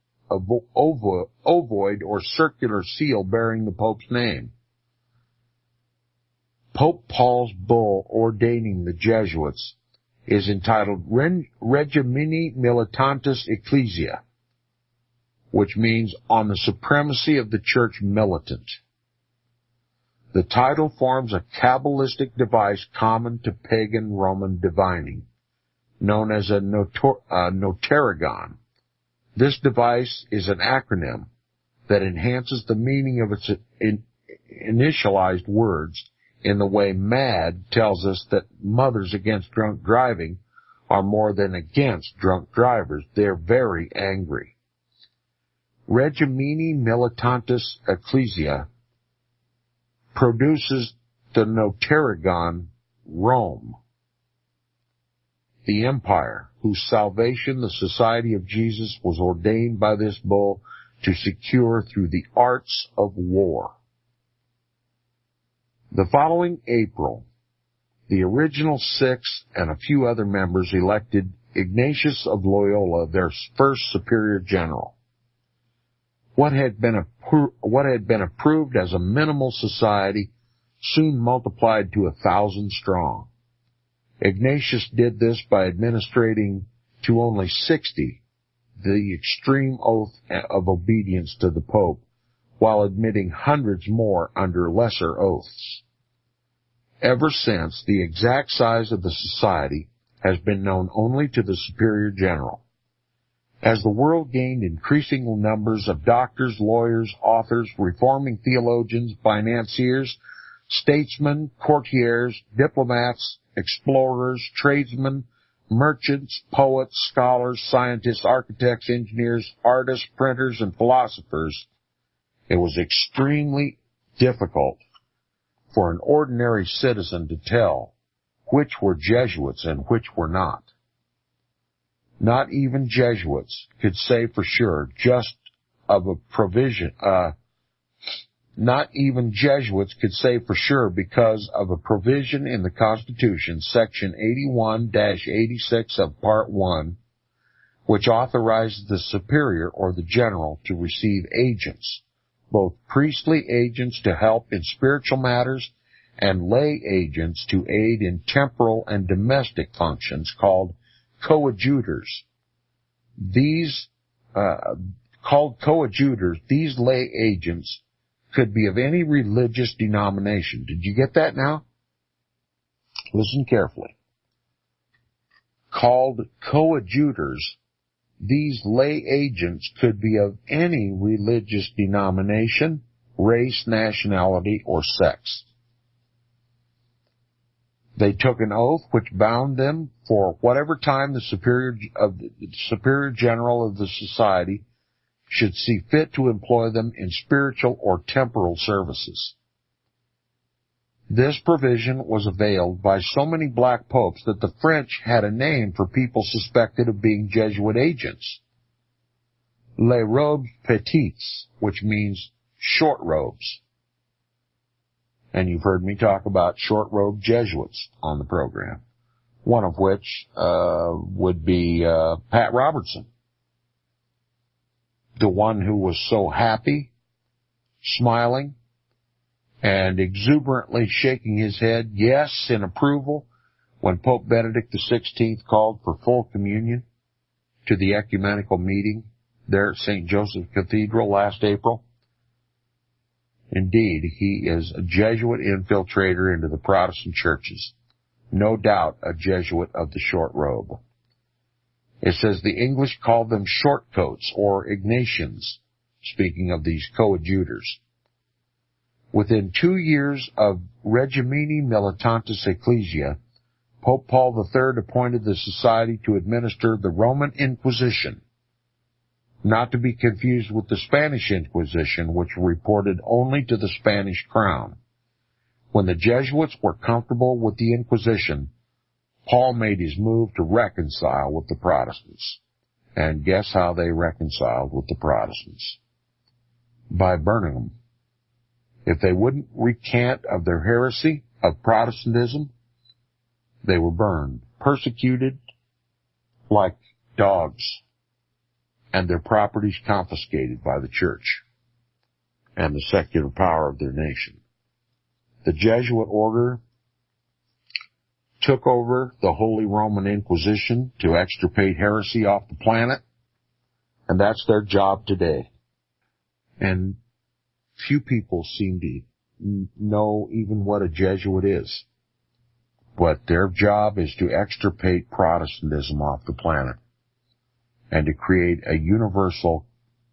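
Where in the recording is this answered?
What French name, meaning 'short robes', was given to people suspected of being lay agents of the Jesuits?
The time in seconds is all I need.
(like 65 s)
209 s.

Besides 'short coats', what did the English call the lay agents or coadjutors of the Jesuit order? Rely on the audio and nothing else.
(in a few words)
Ignatians.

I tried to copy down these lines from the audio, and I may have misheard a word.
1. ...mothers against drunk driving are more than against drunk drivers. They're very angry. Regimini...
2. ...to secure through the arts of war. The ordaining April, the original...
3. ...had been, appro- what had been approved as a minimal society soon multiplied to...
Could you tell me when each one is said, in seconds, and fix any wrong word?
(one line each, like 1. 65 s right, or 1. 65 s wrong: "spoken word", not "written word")
1. 38 s right
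2. 61 s wrong: "following", not "ordaining"
3. 76 s right.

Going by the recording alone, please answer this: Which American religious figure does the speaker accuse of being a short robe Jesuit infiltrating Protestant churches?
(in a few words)
Pat Robertson.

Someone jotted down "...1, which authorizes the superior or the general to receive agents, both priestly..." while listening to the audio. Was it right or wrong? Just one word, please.
right.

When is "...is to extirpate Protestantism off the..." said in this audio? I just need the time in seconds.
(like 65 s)
323 s.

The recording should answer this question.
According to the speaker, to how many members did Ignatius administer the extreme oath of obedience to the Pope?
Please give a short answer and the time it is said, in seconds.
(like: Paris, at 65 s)
60, at 87 s.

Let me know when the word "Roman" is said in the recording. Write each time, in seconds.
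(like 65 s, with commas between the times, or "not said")
24 s, 266 s, 309 s.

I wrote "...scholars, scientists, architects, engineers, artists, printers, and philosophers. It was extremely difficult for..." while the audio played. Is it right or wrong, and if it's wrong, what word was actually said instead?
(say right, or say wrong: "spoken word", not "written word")
right.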